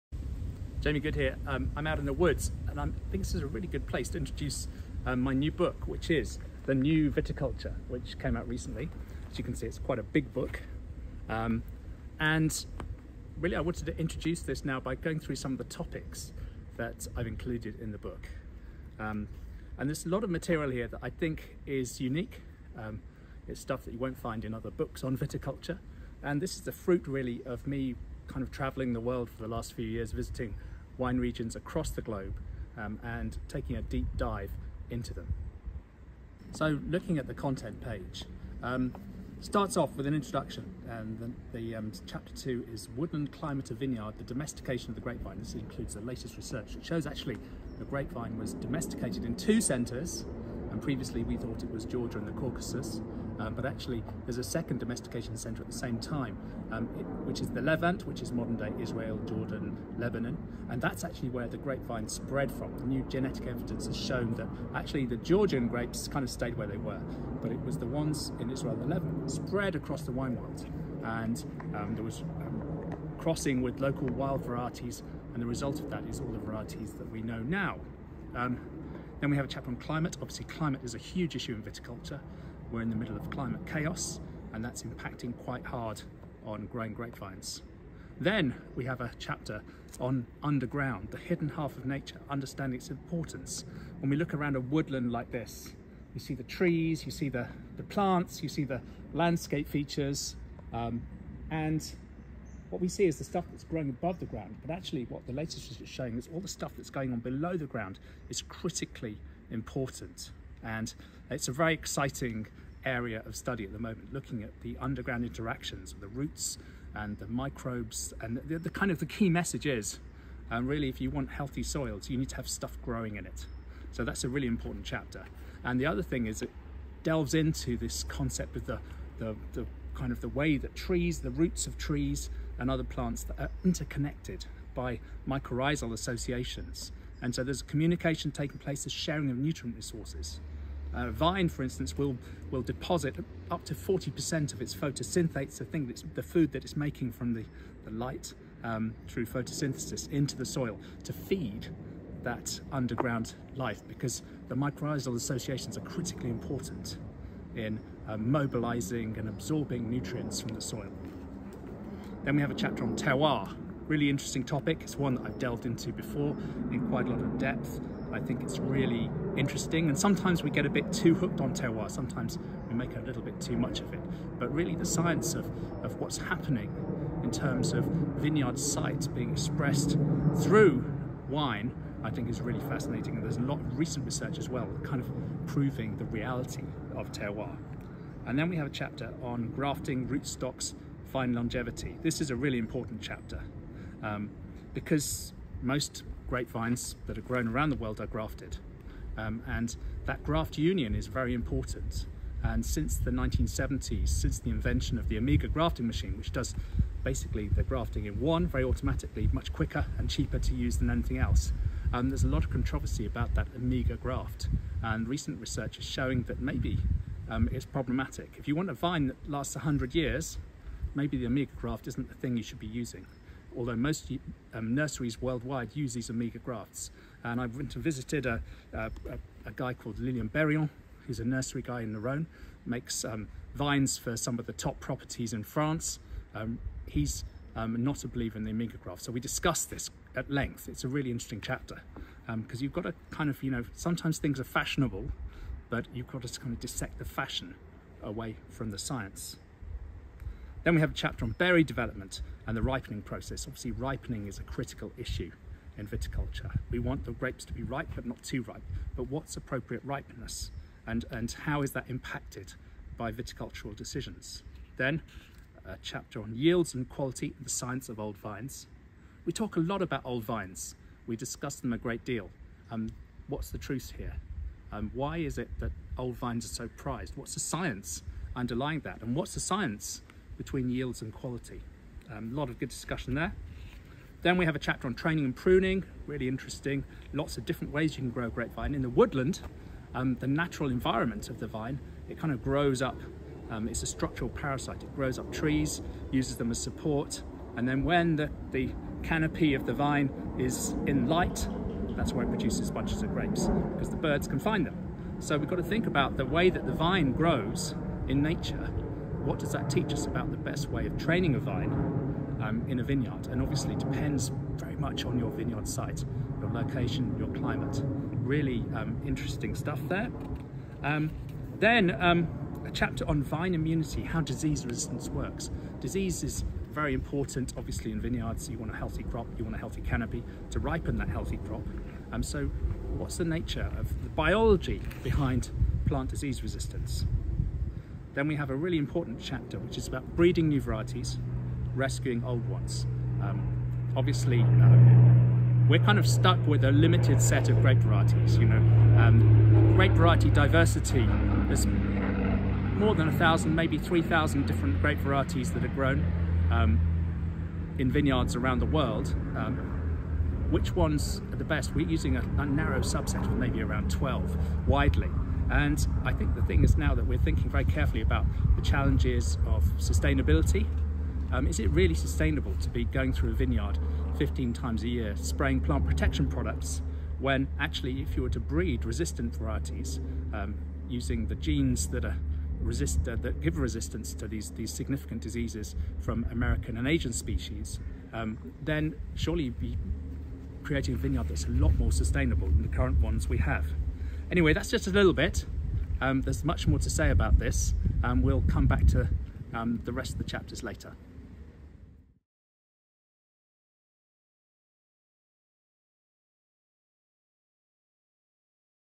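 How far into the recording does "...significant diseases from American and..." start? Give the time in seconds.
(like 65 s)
384 s.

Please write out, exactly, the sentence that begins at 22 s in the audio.
Um, it's stuff that you won't find in other books on viticulture.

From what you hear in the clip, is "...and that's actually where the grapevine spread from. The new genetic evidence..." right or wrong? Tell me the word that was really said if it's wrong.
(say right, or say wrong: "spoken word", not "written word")
right.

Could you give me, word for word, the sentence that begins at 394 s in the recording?
Anyway, that's just a little bit.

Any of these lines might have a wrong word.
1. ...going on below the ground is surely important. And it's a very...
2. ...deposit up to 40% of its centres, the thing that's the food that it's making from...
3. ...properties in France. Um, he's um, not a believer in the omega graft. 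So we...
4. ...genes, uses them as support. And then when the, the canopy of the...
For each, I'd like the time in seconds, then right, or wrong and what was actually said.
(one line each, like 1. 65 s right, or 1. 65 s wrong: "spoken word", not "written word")
1. 106 s wrong: "critically", not "surely"
2. 142 s wrong: "photosynthates", not "centres"
3. 234 s right
4. 295 s wrong: "trees", not "genes".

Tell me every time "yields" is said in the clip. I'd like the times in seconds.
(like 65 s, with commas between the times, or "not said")
266 s, 280 s.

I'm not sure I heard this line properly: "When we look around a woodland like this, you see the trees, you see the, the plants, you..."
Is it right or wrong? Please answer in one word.
right.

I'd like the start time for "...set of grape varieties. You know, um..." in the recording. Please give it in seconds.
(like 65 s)
347 s.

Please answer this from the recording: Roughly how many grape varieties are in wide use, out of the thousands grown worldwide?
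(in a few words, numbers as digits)
around 12.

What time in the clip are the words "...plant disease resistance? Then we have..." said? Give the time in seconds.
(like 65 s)
335 s.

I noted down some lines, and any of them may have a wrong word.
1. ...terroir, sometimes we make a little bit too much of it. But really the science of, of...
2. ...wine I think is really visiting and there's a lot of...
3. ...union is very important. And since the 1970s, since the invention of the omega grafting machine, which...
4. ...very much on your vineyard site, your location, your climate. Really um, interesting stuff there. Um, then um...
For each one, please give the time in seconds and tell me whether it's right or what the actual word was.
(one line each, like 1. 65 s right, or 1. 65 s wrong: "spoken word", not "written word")
1. 171 s right
2. 181 s wrong: "fascinating", not "visiting"
3. 200 s right
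4. 314 s right.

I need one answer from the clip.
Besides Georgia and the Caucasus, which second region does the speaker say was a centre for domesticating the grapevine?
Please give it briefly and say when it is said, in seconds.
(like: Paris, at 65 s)
the Levant, at 57 s.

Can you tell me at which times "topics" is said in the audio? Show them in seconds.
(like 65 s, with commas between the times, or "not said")
15 s, 164 s.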